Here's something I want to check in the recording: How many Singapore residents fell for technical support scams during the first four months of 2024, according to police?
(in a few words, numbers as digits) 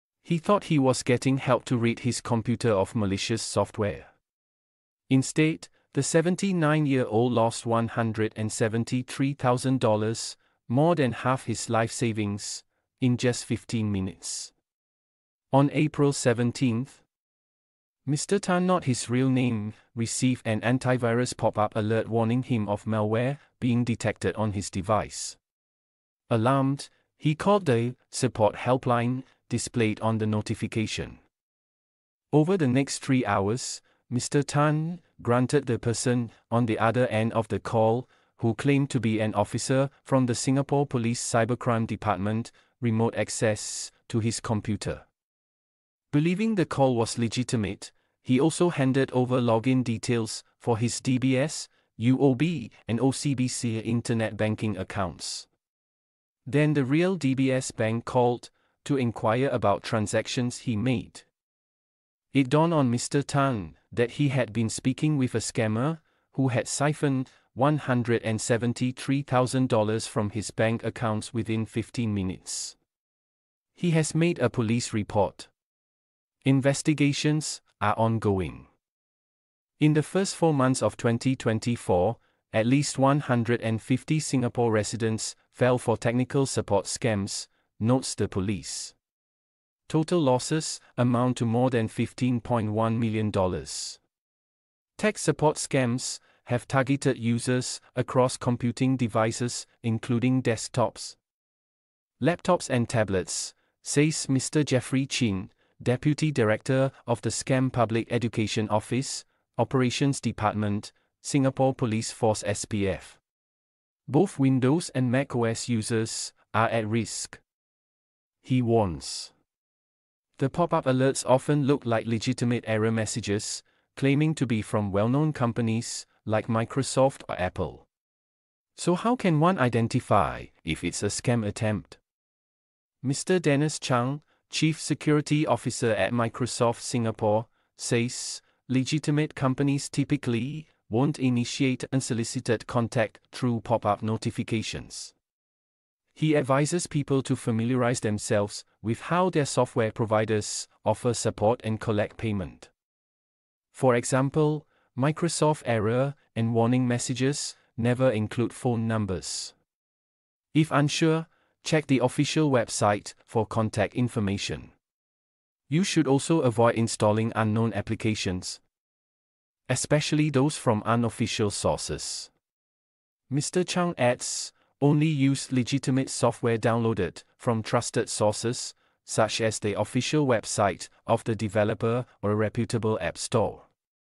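150.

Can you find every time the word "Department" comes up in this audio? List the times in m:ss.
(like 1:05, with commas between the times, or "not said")
0:41, 1:50.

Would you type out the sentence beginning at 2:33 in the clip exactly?
For example, Microsoft error and warning messages never include phone numbers.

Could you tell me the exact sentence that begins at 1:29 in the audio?
Total losses amount to more than $15.1 million.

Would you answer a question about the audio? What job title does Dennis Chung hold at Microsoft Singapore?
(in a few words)
Chief Security Officer.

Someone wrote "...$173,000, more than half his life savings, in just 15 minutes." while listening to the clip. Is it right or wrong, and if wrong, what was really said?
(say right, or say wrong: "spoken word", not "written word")
right.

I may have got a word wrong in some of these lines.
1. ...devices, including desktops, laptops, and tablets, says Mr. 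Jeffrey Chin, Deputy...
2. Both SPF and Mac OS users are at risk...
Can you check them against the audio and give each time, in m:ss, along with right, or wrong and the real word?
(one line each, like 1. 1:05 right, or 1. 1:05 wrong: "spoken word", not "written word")
1. 1:38 right
2. 1:54 wrong: "Windows", not "SPF".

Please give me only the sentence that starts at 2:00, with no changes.
The pop up alerts often look like legitimate error messages, claiming to be from well known companies, like Microsoft or Apple.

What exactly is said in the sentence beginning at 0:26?
Alarmed, he called the support helpline displayed on the notification.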